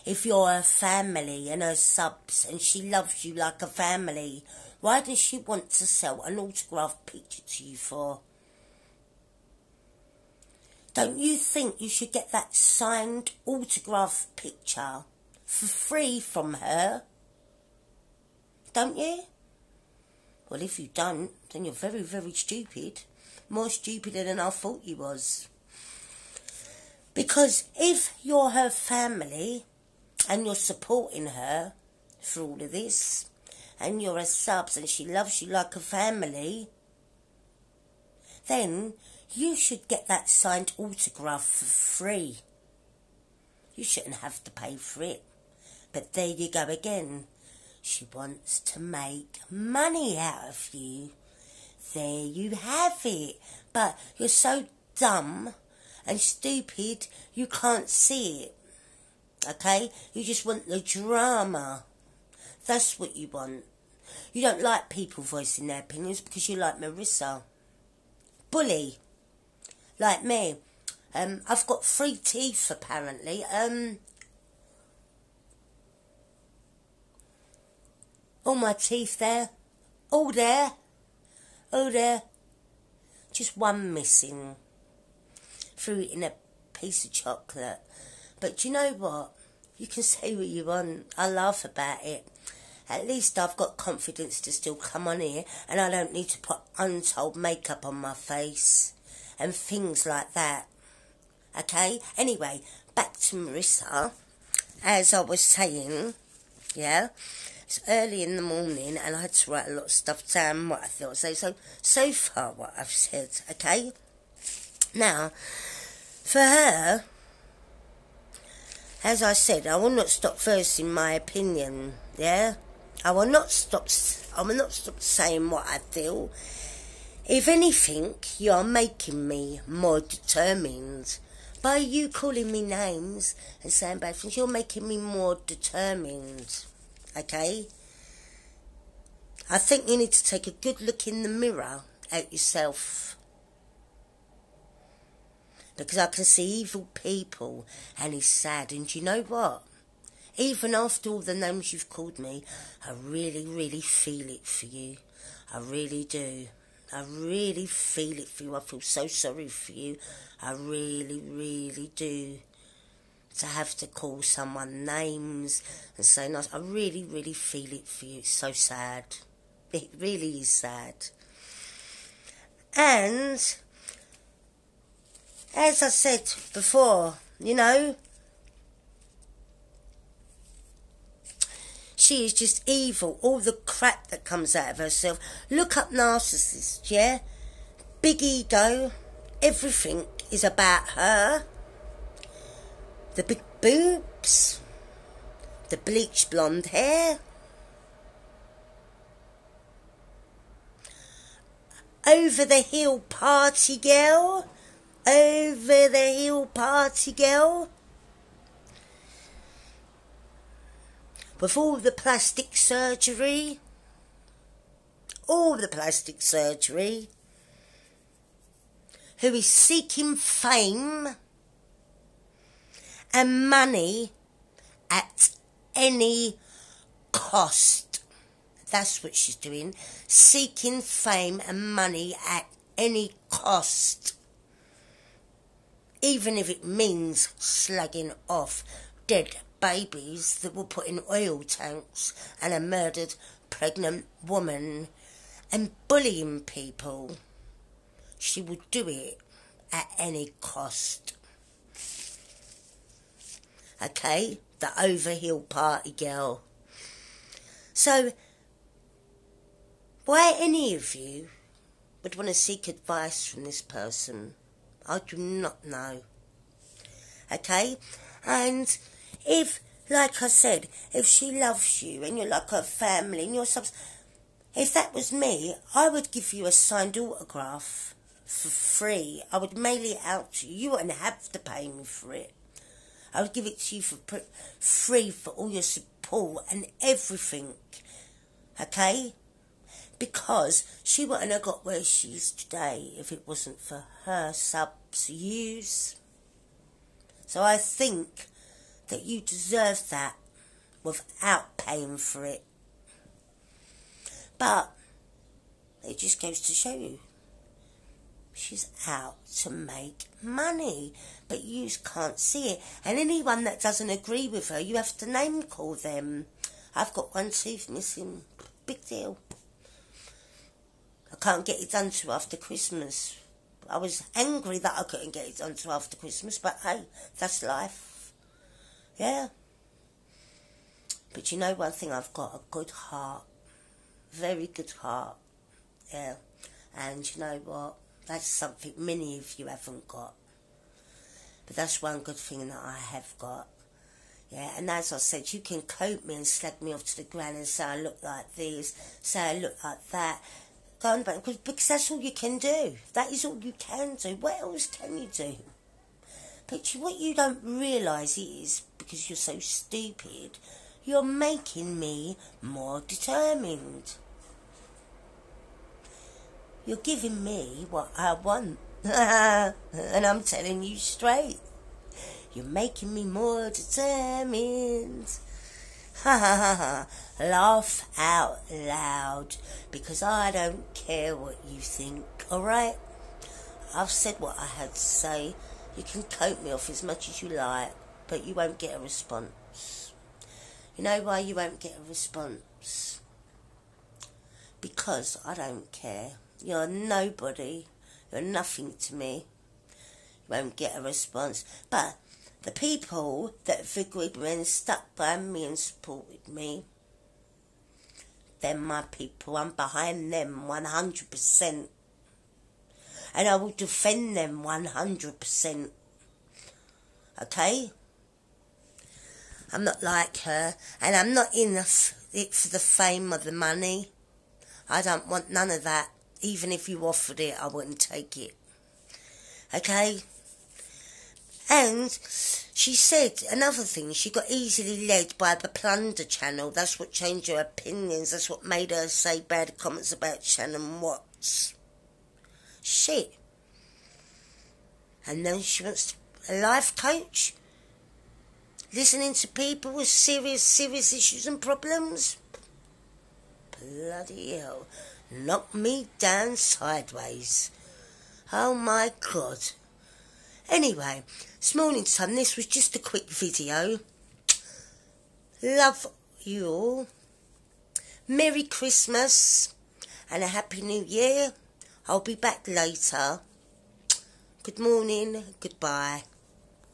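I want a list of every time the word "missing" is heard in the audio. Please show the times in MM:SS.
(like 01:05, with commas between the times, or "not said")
01:23, 05:17.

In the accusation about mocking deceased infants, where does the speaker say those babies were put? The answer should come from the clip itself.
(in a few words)
oil tanks.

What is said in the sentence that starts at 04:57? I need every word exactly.
So I think that you deserve that without paying for it.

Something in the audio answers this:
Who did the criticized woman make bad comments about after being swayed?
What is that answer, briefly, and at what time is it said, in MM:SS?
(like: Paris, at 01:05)
Shanann Watts, at 07:20.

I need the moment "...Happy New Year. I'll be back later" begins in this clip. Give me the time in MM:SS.
07:50.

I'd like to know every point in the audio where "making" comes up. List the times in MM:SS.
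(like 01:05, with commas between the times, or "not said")
02:08, 02:14, 06:01, 06:12.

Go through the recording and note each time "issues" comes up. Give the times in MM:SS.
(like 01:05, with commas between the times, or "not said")
07:30.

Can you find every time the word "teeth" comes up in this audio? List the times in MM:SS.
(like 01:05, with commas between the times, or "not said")
01:12, 01:18.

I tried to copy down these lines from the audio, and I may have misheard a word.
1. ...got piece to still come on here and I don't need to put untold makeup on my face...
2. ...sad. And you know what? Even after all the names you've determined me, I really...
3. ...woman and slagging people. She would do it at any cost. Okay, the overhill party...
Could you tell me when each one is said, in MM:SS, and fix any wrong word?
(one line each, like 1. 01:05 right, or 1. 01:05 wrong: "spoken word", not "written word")
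1. 01:33 wrong: "confidence", not "piece"
2. 02:28 wrong: "called", not "determined"
3. 04:04 wrong: "bullying", not "slagging".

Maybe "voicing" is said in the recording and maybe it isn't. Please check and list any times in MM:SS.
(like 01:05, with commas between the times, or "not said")
01:05.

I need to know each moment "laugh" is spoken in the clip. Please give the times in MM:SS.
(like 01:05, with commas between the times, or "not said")
01:31, 06:17.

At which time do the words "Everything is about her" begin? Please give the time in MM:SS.
03:09.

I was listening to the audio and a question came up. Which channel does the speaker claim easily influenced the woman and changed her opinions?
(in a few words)
Plunder Channel.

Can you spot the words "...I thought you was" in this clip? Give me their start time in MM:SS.
00:24.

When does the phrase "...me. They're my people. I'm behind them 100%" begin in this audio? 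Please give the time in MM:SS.
06:46.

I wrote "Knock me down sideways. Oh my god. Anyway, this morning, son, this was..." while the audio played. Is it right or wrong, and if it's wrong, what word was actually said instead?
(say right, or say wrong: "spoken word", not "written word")
right.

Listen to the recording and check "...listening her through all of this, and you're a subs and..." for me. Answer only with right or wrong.
wrong.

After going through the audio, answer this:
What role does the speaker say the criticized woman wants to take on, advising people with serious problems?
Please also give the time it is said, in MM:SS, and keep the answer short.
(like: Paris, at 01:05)
life coach, at 07:26.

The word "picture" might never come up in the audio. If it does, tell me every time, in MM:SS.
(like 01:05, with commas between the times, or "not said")
00:07, 00:14.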